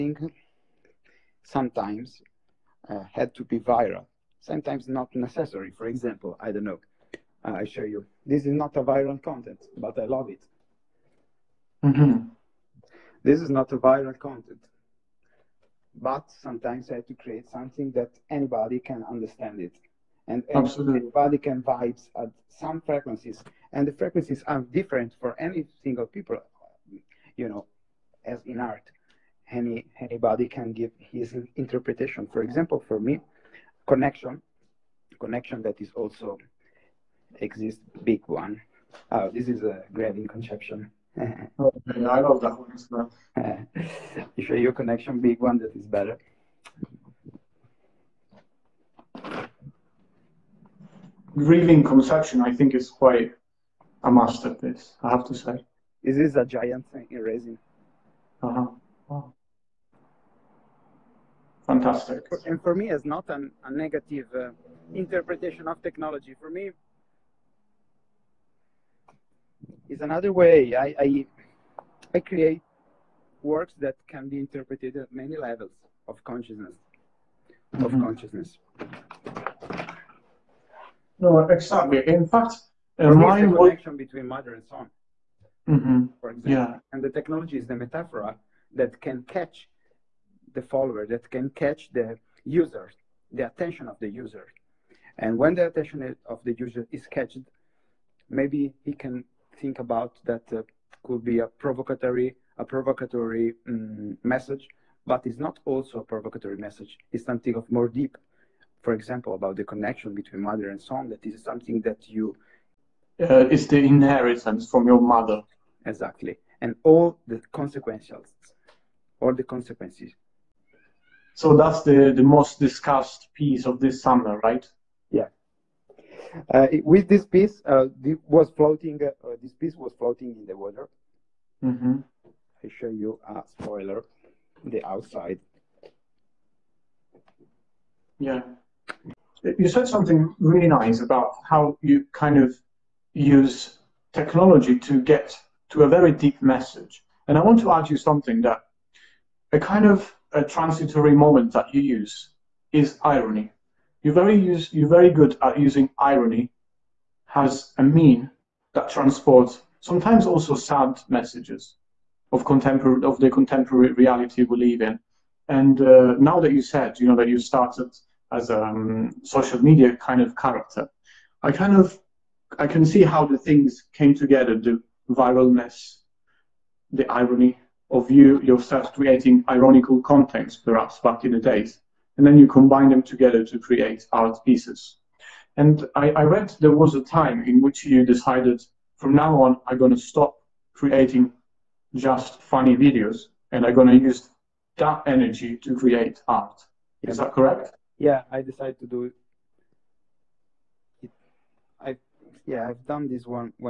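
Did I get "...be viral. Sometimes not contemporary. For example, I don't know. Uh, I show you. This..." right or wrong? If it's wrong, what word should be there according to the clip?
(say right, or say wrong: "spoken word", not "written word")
wrong: "necessary", not "contemporary".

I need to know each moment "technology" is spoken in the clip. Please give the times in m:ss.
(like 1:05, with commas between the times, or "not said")
1:05, 1:27, 2:24.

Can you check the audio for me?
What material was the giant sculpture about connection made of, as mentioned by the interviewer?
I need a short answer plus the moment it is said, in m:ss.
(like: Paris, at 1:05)
Resin, at 0:57.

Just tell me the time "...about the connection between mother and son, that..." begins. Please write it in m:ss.
1:49.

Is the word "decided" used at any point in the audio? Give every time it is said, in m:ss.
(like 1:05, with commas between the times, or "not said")
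3:08, 3:18.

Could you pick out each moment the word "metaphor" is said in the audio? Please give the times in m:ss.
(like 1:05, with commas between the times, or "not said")
1:27.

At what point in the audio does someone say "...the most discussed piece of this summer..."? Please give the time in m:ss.
2:02.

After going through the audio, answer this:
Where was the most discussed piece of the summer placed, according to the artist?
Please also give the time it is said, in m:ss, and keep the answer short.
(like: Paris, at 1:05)
In the water, at 2:10.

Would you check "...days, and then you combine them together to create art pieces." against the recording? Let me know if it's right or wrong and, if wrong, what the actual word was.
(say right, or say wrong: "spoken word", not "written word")
right.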